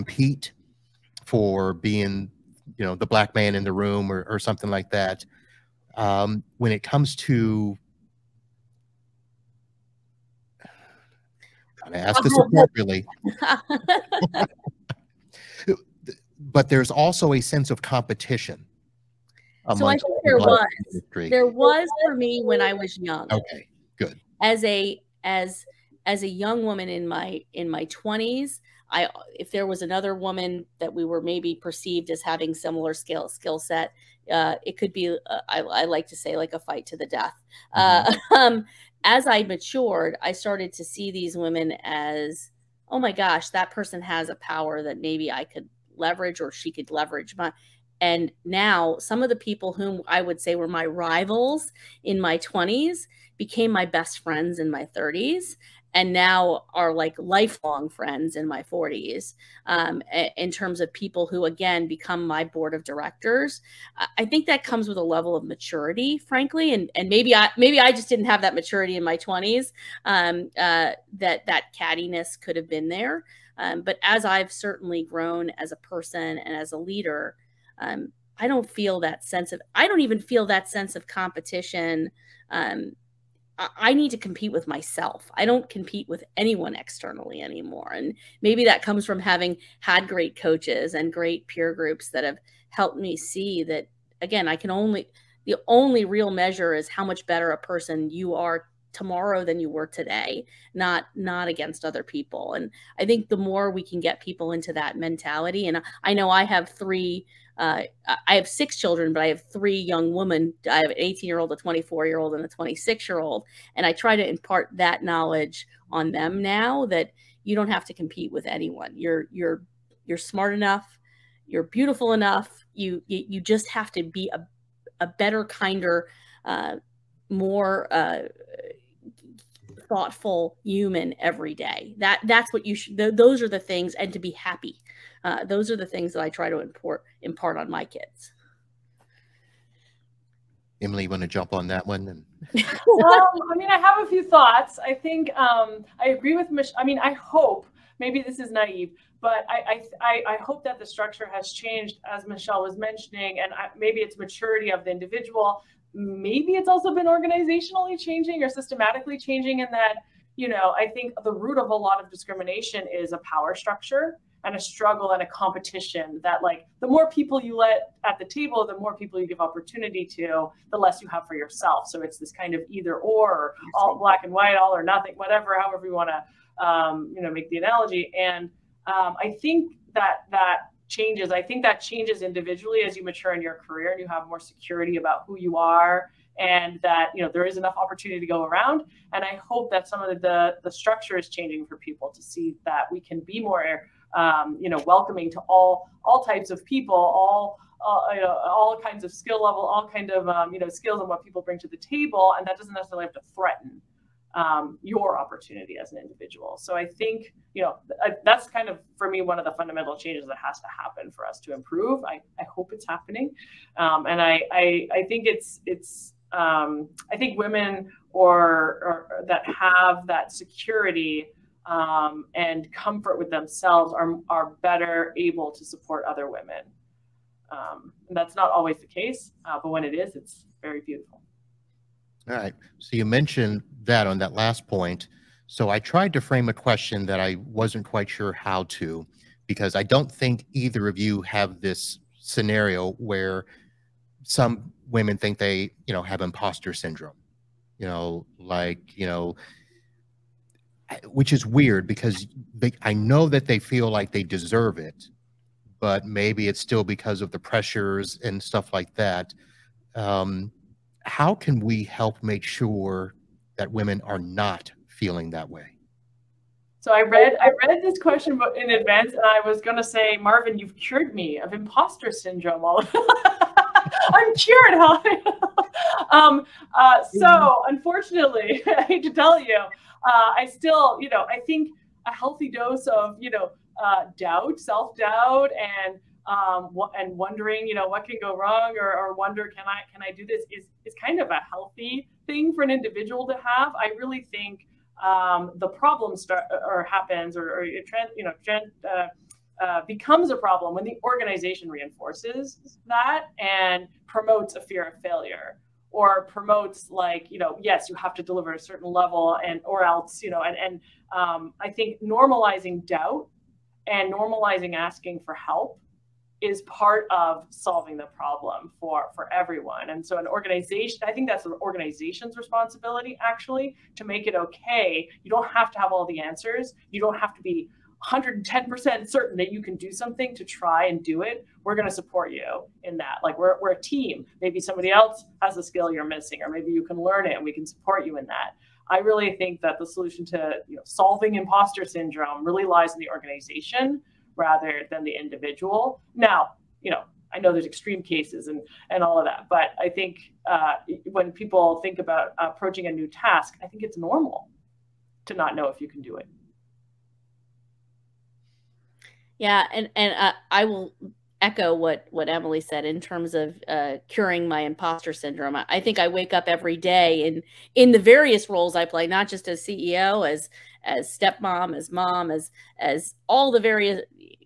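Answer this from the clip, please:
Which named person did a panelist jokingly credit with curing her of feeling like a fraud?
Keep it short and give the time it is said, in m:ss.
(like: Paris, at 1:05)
Marvin, at 4:30.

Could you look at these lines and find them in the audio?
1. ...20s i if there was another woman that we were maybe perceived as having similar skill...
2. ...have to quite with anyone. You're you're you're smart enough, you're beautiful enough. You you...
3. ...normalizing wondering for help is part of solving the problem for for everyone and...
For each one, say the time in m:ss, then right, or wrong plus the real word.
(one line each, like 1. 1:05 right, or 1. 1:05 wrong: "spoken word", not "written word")
1. 0:27 right
2. 1:57 wrong: "compete", not "quite"
3. 5:14 wrong: "asking", not "wondering".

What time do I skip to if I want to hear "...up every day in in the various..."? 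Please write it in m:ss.
6:06.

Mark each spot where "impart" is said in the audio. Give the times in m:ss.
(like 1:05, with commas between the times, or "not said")
1:54, 2:17.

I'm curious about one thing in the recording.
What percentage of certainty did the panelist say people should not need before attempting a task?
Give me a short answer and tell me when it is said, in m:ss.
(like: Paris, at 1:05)
110%, at 5:28.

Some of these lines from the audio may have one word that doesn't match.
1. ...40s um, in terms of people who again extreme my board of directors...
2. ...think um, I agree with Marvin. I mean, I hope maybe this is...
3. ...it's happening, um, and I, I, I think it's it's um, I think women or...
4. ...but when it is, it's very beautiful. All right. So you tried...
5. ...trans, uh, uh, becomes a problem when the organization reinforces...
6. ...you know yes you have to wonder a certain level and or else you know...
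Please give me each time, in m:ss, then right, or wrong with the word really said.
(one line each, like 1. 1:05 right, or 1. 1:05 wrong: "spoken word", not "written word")
1. 0:58 wrong: "become", not "extreme"
2. 2:24 wrong: "Michelle", not "Marvin"
3. 3:32 right
4. 3:49 wrong: "mentioned", not "tried"
5. 4:58 right
6. 5:07 wrong: "deliver", not "wonder".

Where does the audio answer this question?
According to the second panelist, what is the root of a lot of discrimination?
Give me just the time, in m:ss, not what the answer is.
2:43.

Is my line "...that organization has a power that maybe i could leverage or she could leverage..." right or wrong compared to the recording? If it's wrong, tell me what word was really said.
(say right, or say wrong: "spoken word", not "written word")
wrong: "person", not "organization".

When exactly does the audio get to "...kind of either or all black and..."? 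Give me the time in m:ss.
2:52.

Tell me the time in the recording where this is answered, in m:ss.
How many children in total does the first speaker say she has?
1:48.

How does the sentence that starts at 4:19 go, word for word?
Um, how can we help make sure that women are not feeling that way?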